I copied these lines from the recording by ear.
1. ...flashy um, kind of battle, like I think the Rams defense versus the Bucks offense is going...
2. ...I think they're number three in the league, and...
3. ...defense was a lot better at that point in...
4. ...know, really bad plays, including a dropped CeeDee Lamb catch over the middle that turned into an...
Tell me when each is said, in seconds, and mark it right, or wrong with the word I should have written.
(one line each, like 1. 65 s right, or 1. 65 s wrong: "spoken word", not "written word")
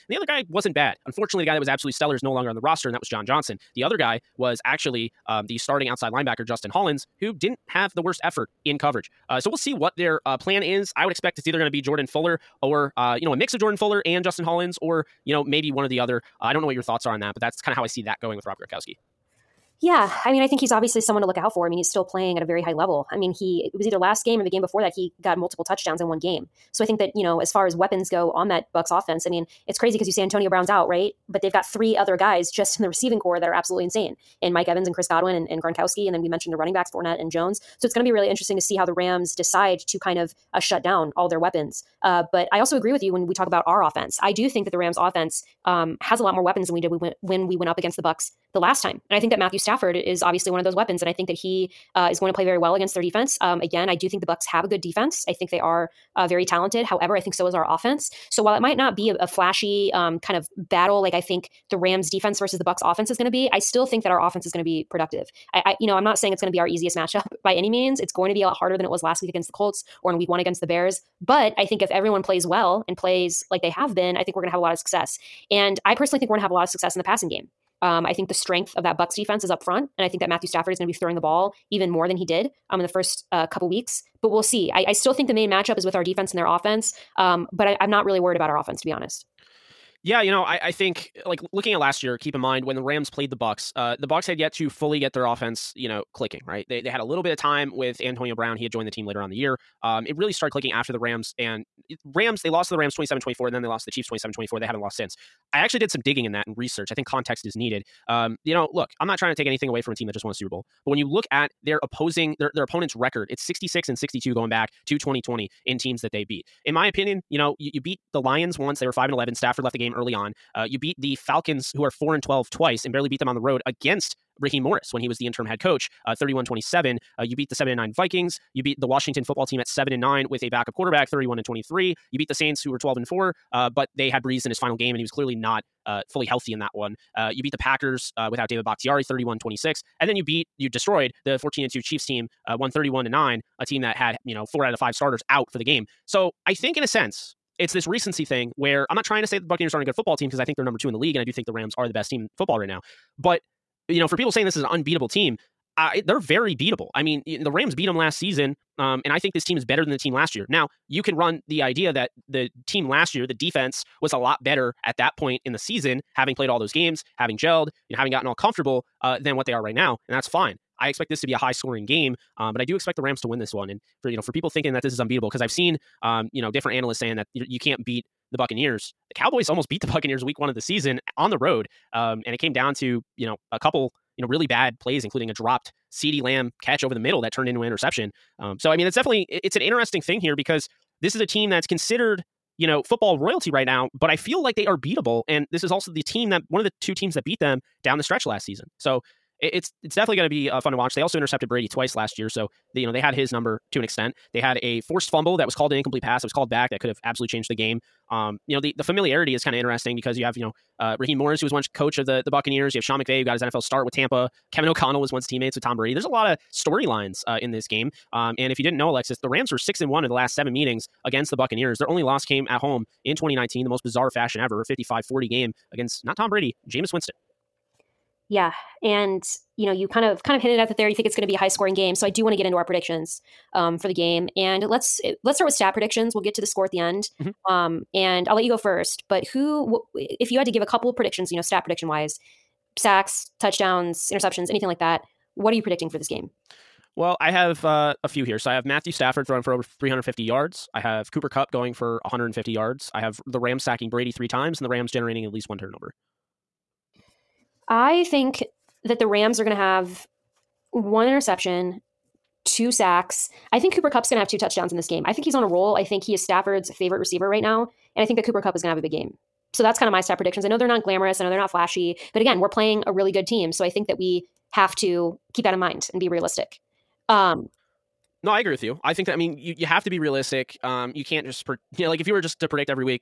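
1. 59 s right
2. 150 s wrong: "two", not "three"
3. 163 s right
4. 184 s right.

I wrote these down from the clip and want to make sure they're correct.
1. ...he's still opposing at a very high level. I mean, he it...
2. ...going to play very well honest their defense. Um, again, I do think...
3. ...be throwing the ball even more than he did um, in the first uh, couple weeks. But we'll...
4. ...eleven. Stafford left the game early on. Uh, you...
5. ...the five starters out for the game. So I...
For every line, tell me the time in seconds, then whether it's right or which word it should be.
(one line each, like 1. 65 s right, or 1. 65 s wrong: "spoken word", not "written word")
1. 21 s wrong: "playing", not "opposing"
2. 52 s wrong: "against", not "honest"
3. 80 s right
4. 119 s right
5. 144 s right.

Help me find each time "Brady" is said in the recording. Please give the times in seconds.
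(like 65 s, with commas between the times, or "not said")
201 s, 215 s, 226 s, 253 s.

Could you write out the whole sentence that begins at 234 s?
And let's let's start with stat predictions.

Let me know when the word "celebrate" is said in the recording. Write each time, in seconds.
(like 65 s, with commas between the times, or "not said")
not said.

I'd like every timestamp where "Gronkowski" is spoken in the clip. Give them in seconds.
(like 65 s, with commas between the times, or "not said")
18 s, 35 s.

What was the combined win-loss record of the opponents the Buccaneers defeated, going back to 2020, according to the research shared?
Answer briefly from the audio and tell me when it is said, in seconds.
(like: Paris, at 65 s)
66-62, at 113 s.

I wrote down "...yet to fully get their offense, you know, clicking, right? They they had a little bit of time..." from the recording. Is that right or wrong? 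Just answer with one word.
right.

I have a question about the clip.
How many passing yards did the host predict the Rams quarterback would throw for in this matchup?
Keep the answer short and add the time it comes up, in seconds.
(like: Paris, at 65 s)
over 350, at 249 s.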